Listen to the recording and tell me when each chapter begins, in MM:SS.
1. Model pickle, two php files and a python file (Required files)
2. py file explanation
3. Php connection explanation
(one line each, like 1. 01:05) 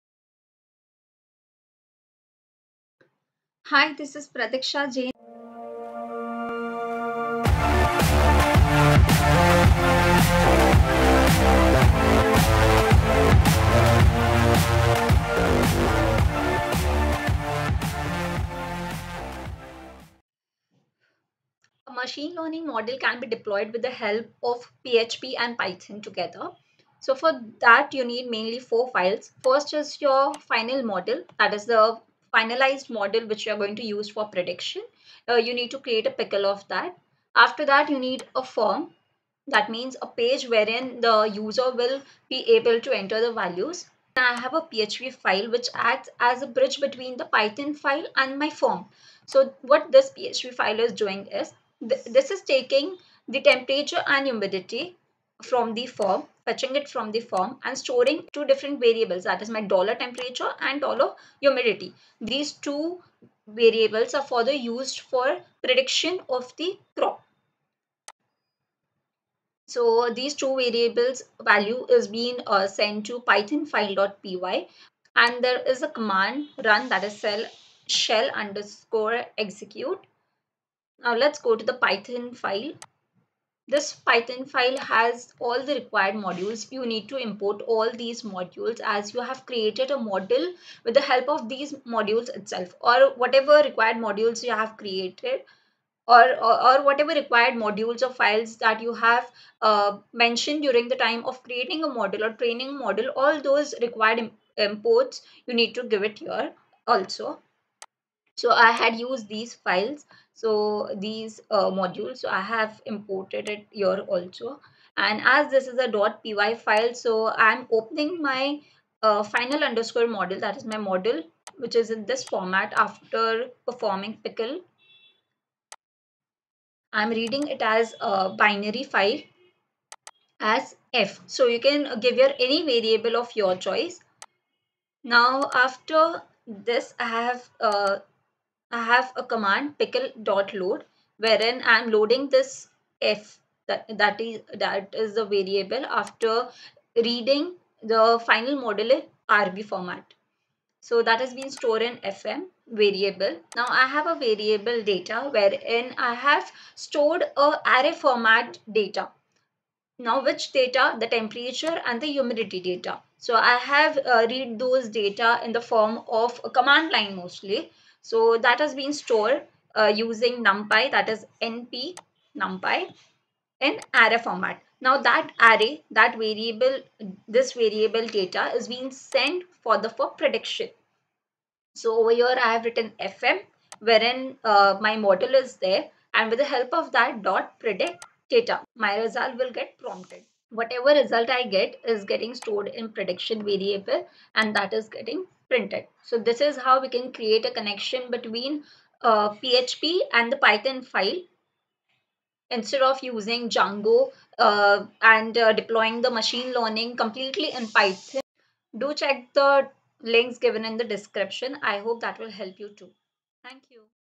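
1. 00:19
2. 01:20
3. 00:46.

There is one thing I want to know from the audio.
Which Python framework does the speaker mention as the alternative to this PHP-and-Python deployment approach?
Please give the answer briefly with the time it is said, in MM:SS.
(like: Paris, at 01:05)
Django, at 03:23.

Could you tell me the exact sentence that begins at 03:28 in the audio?
Do check the links given in the description.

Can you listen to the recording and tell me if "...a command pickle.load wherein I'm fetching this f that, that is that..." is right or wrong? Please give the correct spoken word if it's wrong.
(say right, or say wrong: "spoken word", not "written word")
wrong: "loading", not "fetching".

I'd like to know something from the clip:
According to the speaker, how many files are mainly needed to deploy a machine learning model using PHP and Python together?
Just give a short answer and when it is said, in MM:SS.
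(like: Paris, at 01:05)
4, at 00:28.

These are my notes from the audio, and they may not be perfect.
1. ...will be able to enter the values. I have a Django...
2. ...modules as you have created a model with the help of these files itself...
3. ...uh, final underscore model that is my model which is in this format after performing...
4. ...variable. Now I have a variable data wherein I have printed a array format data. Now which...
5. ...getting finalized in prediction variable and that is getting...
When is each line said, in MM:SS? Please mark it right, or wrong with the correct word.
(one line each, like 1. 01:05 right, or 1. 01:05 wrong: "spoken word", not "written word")
1. 00:41 wrong: "PHP", not "Django"
2. 01:28 wrong: "modules", not "files"
3. 01:59 right
4. 02:32 wrong: "stored", not "printed"
5. 03:12 wrong: "stored", not "finalized".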